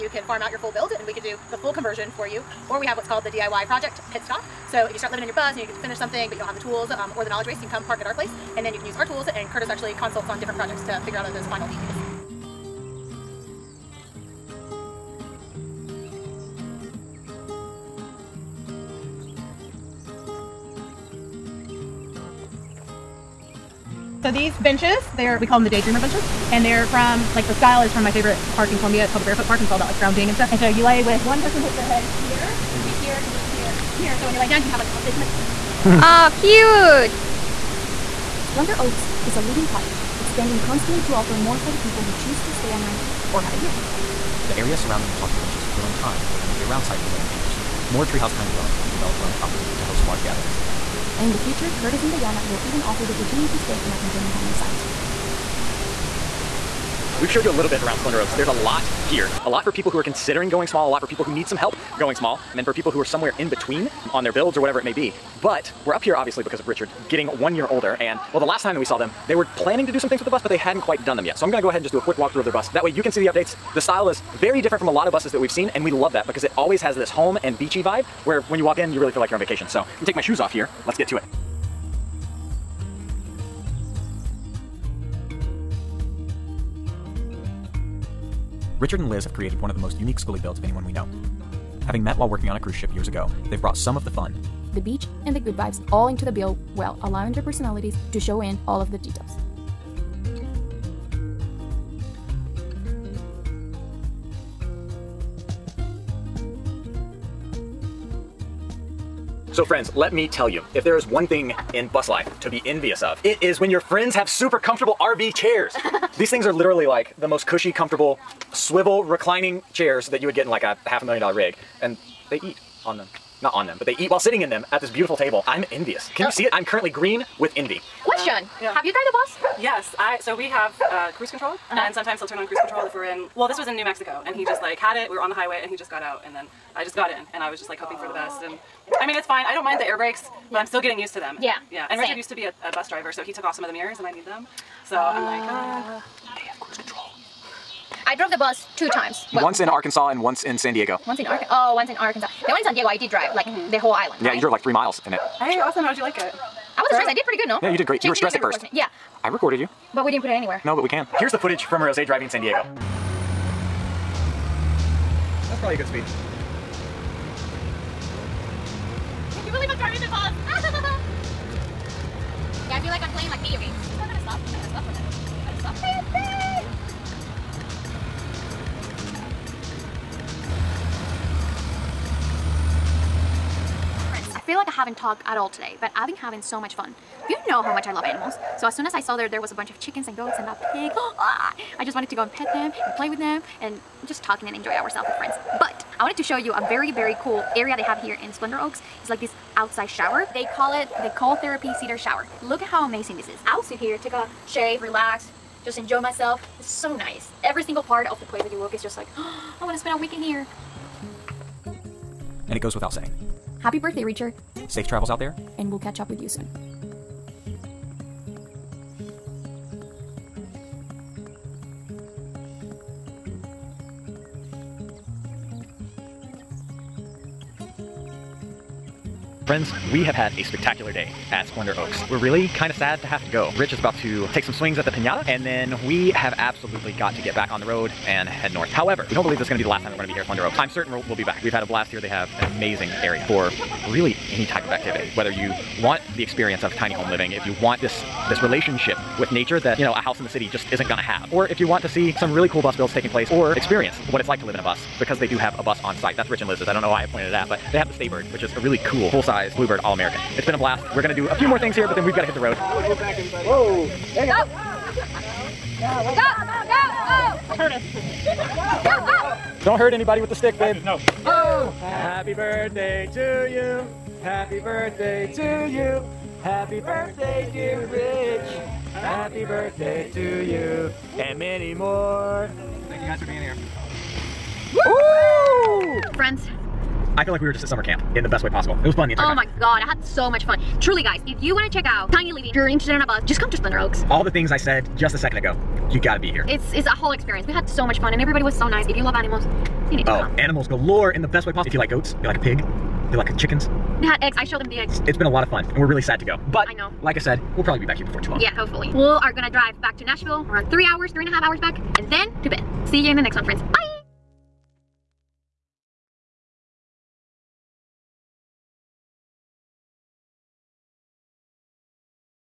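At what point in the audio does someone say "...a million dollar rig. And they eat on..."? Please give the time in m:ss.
2:01.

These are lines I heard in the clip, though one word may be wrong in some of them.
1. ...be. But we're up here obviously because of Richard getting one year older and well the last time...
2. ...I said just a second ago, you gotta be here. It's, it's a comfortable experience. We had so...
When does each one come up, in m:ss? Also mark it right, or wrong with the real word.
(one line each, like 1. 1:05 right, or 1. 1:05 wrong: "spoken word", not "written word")
1. 1:04 right
2. 4:54 wrong: "whole", not "comfortable".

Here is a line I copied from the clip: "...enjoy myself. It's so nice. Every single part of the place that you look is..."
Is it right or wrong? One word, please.
right.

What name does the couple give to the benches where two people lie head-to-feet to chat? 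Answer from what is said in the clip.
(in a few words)
daydreamer benches.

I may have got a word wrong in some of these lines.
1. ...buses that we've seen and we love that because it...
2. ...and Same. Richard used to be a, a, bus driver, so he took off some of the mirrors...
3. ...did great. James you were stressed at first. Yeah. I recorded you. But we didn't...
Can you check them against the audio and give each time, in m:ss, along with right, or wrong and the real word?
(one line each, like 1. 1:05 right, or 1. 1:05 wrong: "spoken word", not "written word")
1. 1:15 right
2. 2:21 right
3. 2:37 right.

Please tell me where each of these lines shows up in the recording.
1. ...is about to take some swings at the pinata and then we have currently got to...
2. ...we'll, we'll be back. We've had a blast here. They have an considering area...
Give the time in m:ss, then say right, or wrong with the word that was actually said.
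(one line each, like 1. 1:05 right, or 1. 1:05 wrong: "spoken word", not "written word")
1. 3:53 wrong: "absolutely", not "currently"
2. 4:00 wrong: "amazing", not "considering".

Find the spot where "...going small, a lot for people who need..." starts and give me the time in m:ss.
1:00.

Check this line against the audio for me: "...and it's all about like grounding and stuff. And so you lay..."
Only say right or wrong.
right.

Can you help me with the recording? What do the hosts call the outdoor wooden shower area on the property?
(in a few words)
cold therapy cedar shower.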